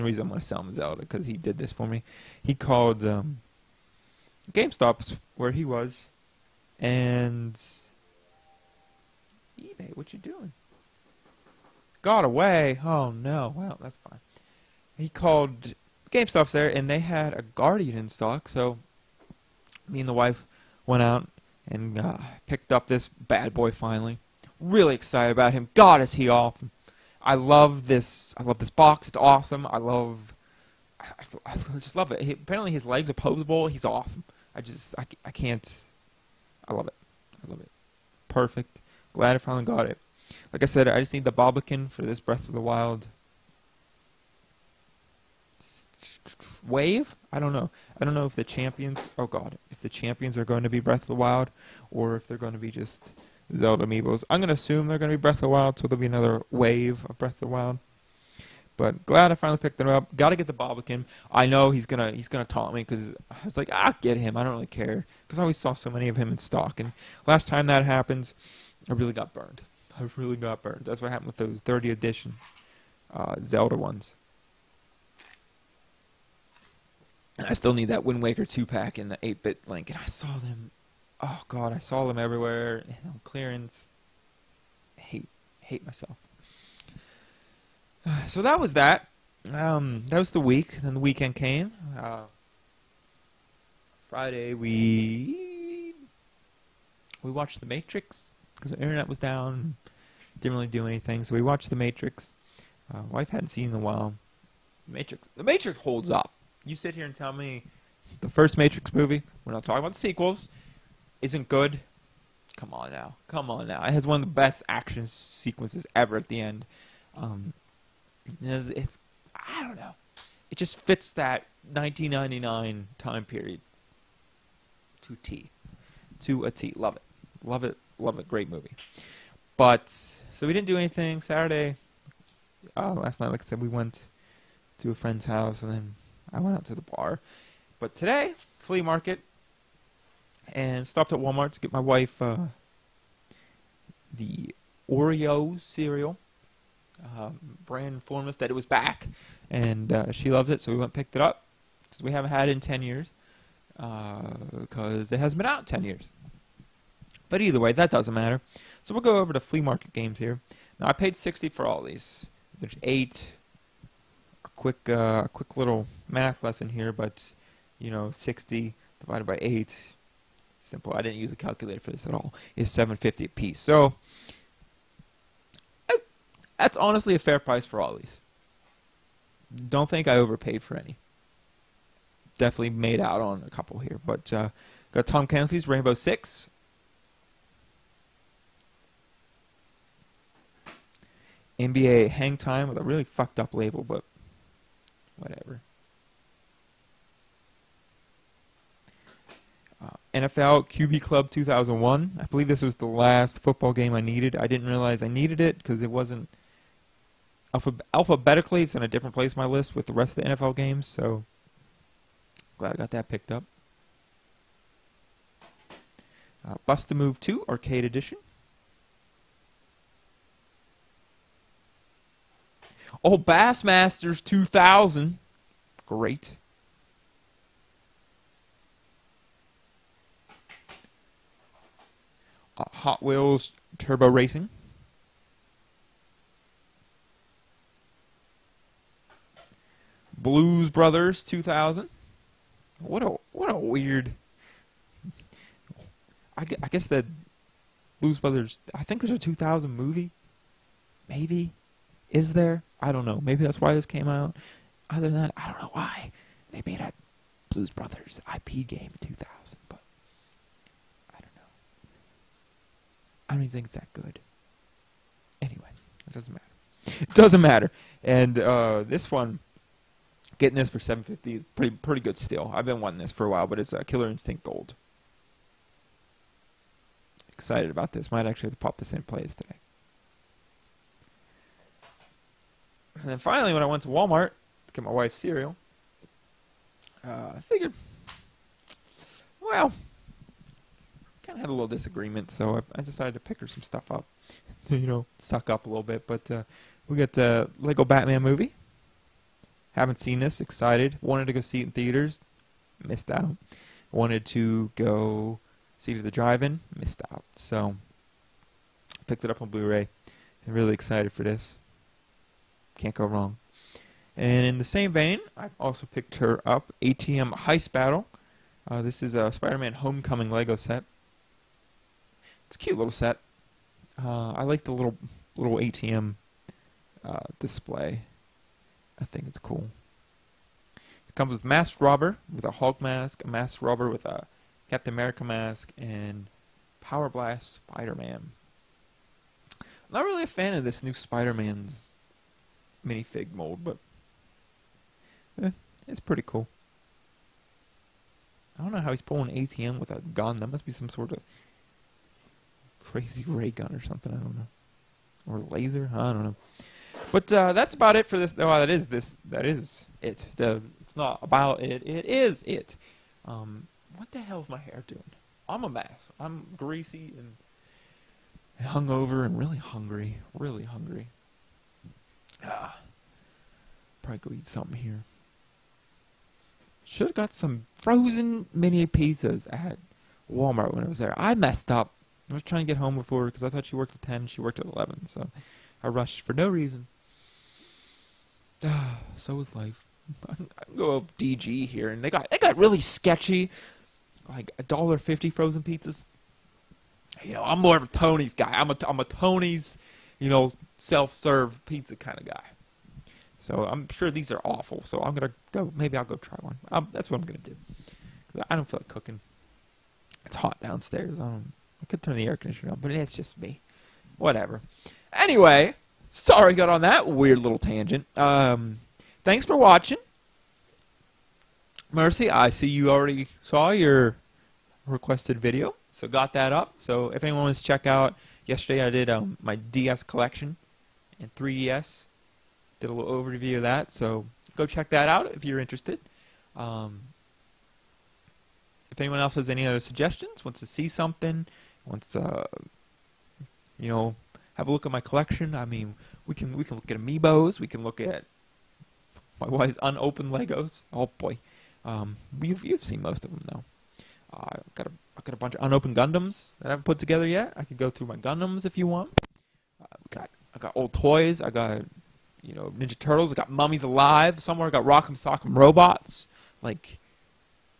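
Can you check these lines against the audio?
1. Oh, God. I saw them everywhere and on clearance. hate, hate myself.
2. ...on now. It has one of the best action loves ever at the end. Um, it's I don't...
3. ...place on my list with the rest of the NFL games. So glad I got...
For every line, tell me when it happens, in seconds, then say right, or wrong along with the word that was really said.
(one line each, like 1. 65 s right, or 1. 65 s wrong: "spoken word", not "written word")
1. 81 s right
2. 113 s wrong: "sequences", not "loves"
3. 209 s right.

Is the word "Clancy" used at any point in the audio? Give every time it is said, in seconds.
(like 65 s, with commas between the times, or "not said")
185 s.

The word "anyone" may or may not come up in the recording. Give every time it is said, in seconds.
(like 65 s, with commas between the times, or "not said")
427 s, 438 s.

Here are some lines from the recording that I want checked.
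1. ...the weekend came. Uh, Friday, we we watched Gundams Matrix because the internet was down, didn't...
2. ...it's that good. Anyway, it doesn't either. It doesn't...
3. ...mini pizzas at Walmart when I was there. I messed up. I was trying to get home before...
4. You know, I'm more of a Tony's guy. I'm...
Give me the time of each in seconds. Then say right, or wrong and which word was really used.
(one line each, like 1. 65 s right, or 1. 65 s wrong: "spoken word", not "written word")
1. 90 s wrong: "The", not "Gundams"
2. 263 s wrong: "matter", not "either"
3. 378 s right
4. 397 s right.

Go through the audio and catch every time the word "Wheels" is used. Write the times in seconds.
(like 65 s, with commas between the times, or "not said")
233 s.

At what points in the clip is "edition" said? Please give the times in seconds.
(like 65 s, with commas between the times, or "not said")
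71 s, 217 s.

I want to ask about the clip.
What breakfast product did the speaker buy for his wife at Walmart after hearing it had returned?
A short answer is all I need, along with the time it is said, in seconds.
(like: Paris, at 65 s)
Oreo cereal, at 144 s.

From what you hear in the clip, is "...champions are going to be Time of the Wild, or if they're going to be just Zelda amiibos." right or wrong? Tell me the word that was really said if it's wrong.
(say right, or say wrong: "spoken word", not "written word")
wrong: "Breath", not "Time".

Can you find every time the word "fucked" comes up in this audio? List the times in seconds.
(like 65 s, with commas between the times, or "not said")
193 s.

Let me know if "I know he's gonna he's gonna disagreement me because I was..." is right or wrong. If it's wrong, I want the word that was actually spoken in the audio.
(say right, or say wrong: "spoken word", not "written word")
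wrong: "taunt", not "disagreement".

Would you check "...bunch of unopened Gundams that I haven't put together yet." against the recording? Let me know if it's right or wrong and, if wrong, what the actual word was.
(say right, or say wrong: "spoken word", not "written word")
right.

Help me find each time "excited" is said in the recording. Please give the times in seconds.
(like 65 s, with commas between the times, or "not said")
24 s, 277 s, 300 s, 310 s.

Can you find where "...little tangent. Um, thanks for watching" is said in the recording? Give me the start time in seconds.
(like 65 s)
417 s.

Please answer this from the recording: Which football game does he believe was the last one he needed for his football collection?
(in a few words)
NFL QB Club 2001.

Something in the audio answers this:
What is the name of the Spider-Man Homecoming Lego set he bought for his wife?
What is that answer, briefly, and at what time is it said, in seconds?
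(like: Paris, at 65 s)
ATM Heist Battle, at 316 s.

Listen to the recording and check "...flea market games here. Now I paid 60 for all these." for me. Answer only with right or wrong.
right.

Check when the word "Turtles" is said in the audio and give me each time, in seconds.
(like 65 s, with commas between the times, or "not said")
462 s.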